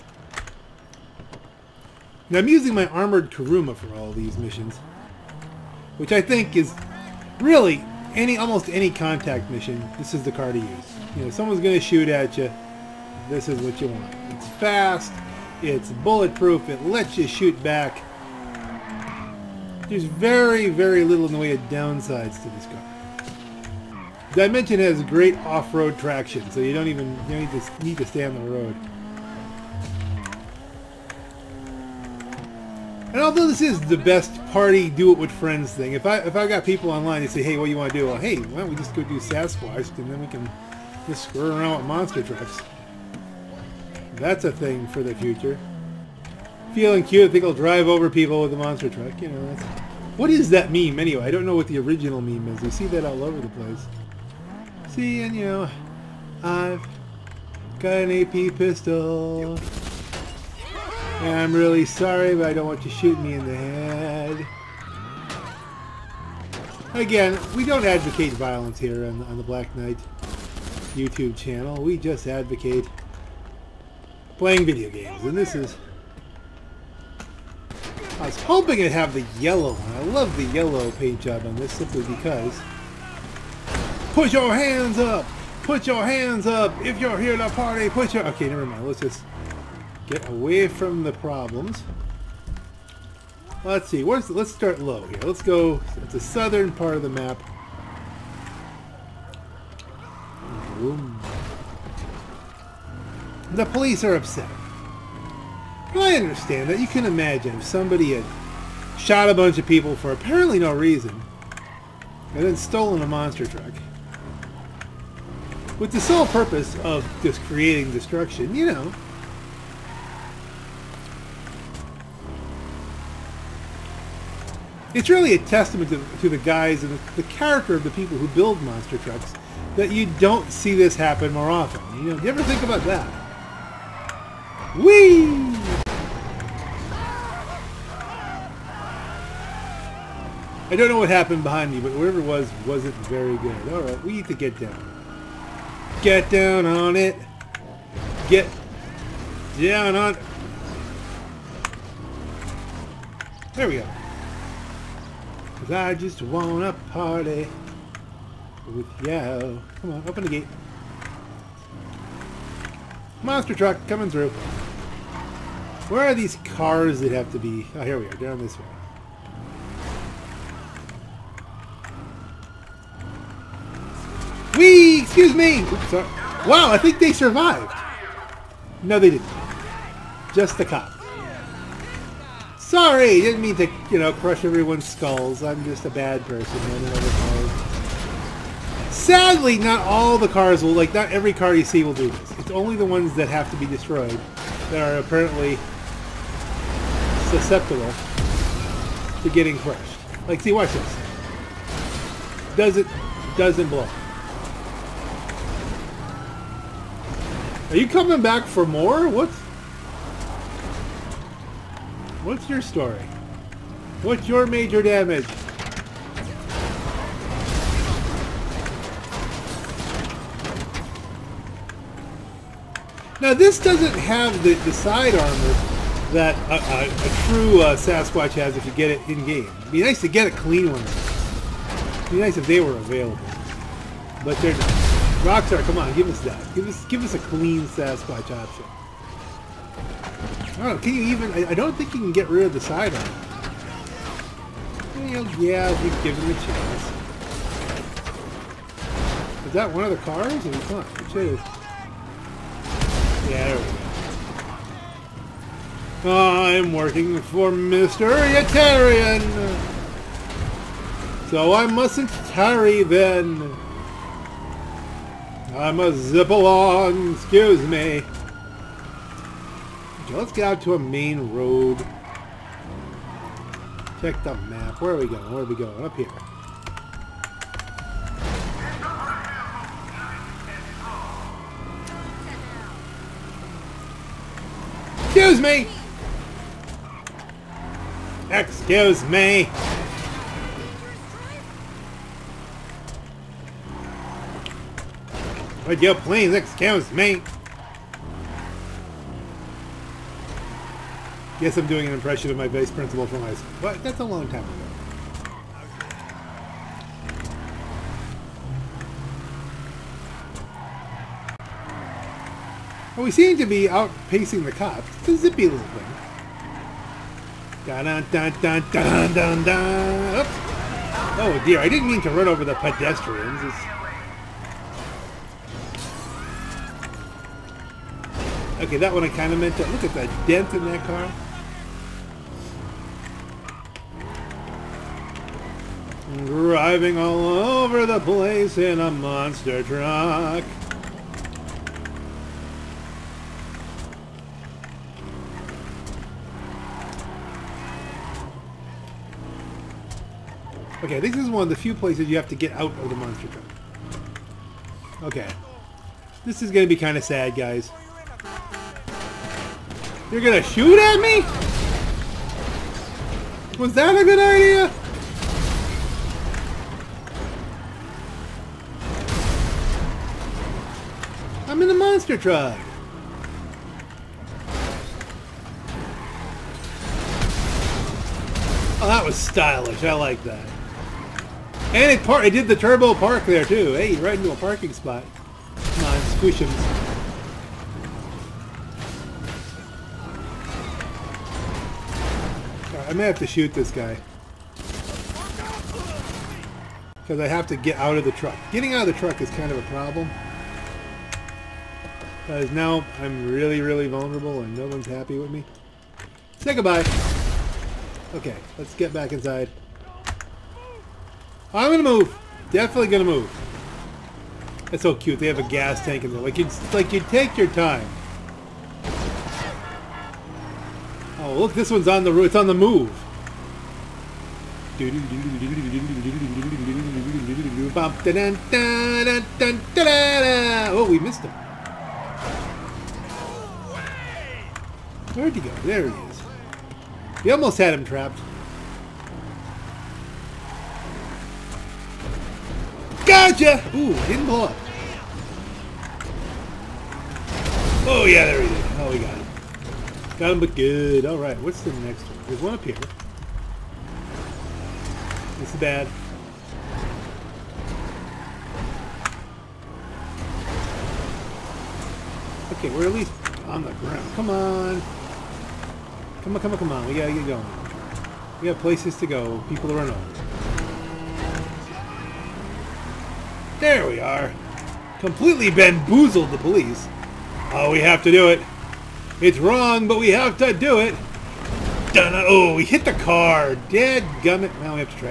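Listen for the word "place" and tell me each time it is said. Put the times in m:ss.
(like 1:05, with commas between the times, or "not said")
0:53, 5:37, 5:51, 7:48.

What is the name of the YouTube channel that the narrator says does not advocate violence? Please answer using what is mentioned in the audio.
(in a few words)
Black Knight.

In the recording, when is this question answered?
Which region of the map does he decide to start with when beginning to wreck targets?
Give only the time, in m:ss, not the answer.
1:36.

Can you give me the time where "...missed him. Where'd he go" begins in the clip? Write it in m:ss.
7:10.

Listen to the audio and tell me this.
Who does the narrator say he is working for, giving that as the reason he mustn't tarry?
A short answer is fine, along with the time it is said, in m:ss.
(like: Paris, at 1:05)
Mr. Yetarian, at 4:17.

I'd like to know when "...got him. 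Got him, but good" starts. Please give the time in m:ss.
7:28.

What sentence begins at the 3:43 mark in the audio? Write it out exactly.
Now this doesn't have the, the side armor that a, a, a true uh, Sasquatch has if you get it in-game.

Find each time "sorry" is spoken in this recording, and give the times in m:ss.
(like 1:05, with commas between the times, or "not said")
1:01, 3:02.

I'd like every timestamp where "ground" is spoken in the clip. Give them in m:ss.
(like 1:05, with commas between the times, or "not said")
7:43.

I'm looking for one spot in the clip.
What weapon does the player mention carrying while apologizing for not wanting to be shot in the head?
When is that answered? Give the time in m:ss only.
0:58.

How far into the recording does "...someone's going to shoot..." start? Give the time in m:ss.
0:11.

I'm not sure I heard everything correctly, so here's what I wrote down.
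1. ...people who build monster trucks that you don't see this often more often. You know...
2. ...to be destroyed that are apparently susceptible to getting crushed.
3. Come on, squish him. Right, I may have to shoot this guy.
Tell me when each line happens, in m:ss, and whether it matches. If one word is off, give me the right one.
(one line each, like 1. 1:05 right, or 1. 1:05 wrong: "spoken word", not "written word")
1. 2:07 wrong: "happen", not "often"
2. 3:13 right
3. 6:25 right.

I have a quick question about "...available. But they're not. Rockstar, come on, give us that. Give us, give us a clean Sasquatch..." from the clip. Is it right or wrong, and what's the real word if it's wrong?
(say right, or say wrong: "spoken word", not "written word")
right.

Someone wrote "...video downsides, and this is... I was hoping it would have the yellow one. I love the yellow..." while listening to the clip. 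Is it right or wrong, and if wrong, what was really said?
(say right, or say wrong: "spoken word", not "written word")
wrong: "games", not "downsides".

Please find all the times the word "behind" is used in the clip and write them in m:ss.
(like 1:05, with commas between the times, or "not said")
2:21.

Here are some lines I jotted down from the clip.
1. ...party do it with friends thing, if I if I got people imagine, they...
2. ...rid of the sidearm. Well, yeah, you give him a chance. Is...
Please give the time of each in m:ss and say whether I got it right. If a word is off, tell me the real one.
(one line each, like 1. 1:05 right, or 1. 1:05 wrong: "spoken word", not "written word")
1. 0:34 wrong: "online", not "imagine"
2. 4:02 right.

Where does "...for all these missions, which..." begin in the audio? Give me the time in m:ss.
0:03.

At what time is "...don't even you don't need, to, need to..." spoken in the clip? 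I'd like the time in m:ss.
0:26.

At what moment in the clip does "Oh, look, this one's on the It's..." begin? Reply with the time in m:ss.
7:01.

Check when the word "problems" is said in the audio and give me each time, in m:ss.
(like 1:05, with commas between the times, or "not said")
1:31, 6:39.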